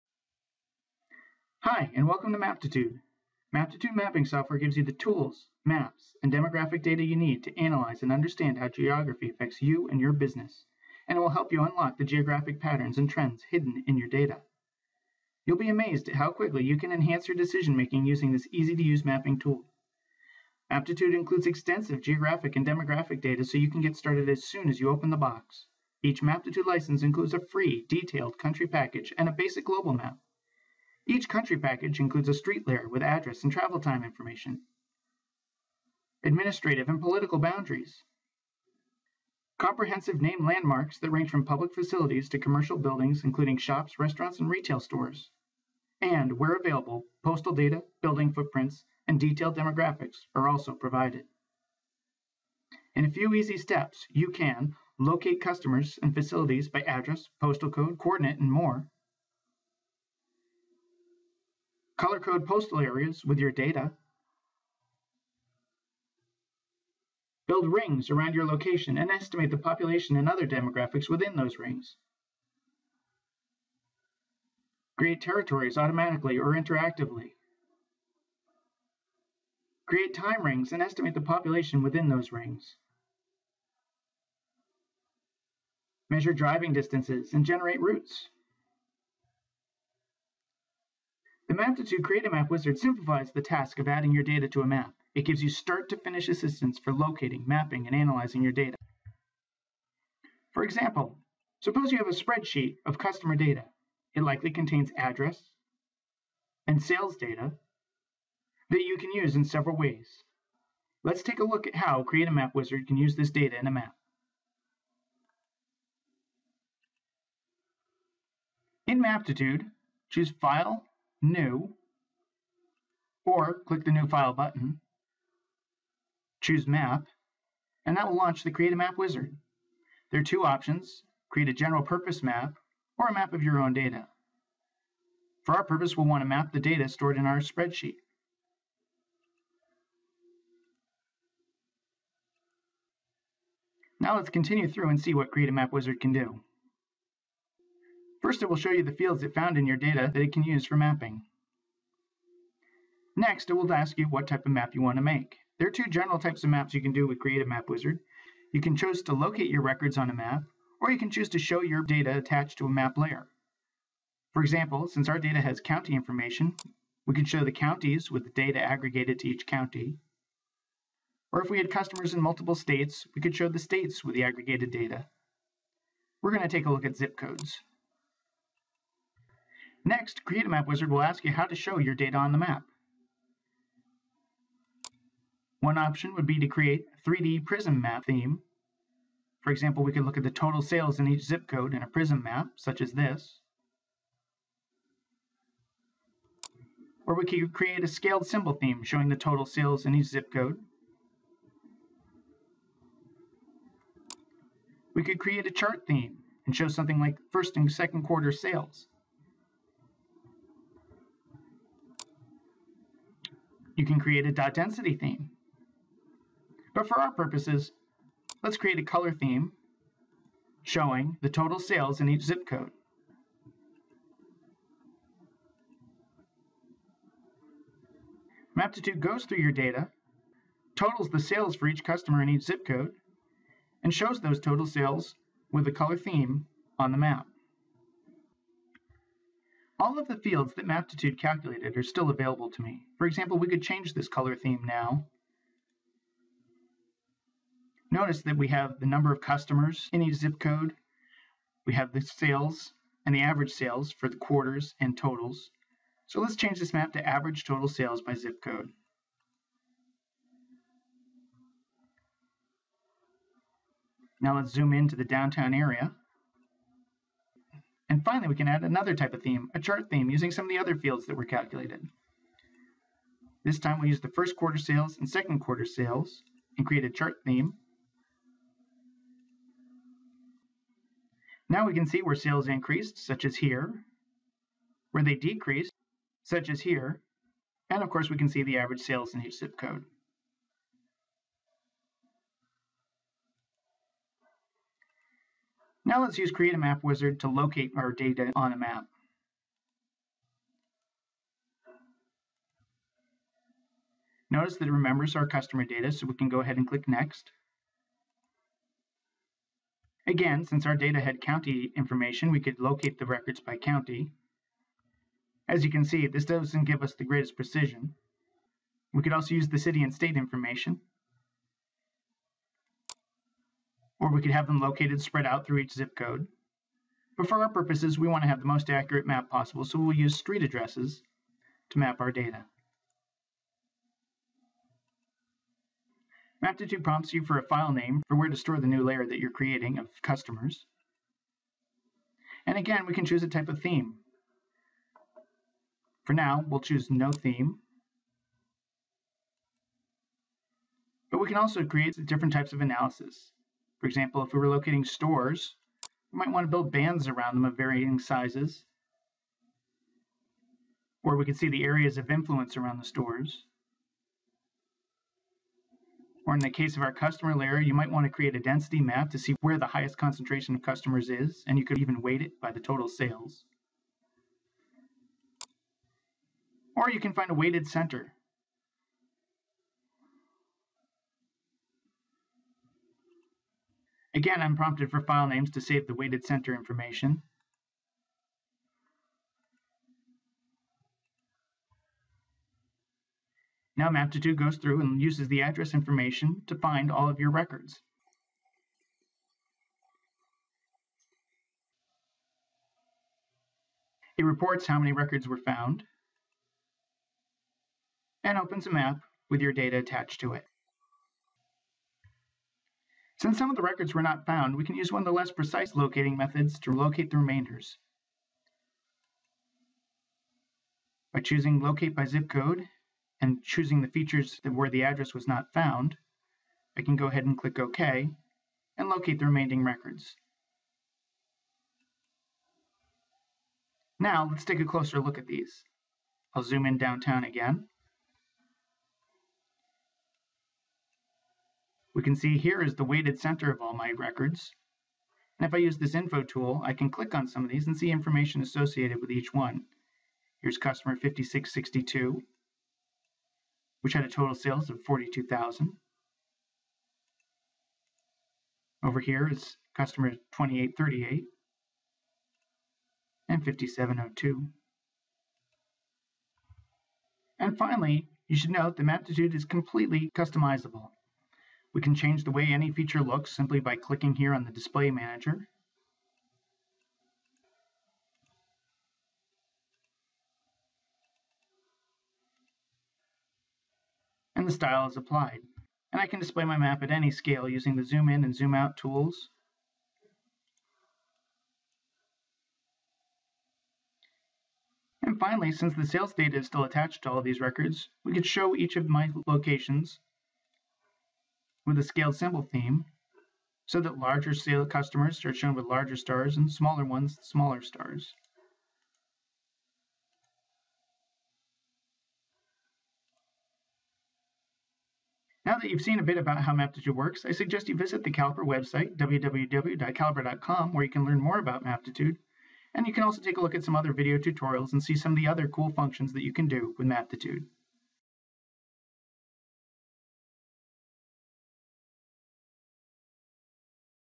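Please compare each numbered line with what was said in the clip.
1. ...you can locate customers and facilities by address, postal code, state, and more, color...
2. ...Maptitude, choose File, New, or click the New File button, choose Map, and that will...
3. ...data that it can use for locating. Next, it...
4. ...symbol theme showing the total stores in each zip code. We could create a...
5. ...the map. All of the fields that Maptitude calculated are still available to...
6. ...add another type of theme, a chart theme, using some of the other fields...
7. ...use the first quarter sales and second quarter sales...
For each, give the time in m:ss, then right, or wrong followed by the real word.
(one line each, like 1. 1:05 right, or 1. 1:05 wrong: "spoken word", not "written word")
1. 0:54 wrong: "coordinate", not "state"
2. 1:58 right
3. 2:29 wrong: "mapping", not "locating"
4. 3:18 wrong: "sales", not "stores"
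5. 3:56 right
6. 4:28 right
7. 4:33 right.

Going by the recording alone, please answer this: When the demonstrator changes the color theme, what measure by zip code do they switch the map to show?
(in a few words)
average total sales.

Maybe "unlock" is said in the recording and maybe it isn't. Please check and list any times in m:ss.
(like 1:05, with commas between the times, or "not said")
0:11.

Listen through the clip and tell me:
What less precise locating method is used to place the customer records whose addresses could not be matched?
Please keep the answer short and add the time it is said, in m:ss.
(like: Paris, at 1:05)
Locate by Zip Code, at 7:01.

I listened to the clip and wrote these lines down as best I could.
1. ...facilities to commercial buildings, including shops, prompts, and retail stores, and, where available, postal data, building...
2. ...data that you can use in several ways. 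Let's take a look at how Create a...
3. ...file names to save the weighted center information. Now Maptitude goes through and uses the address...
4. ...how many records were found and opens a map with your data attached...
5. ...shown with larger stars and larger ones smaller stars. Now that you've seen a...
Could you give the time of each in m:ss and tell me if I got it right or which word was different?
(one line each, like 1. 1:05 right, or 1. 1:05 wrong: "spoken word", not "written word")
1. 0:41 wrong: "restaurants", not "prompts"
2. 1:47 right
3. 6:25 right
4. 6:44 right
5. 8:25 wrong: "smaller", not "larger".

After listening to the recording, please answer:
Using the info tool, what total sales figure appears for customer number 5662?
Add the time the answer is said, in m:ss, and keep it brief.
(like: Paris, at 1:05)
42,000, at 7:34.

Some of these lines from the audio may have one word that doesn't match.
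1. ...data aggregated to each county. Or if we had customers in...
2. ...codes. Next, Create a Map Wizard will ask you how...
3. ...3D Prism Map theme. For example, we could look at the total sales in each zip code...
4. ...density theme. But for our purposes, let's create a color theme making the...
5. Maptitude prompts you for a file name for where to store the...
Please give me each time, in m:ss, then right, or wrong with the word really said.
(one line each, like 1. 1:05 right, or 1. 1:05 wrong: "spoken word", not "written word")
1. 2:48 right
2. 2:57 right
3. 3:07 right
4. 3:34 wrong: "showing", not "making"
5. 5:36 right.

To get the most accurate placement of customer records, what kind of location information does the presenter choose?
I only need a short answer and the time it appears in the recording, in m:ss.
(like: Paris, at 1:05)
street addresses, at 5:30.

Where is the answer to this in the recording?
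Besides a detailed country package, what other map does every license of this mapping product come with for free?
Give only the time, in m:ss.
0:29.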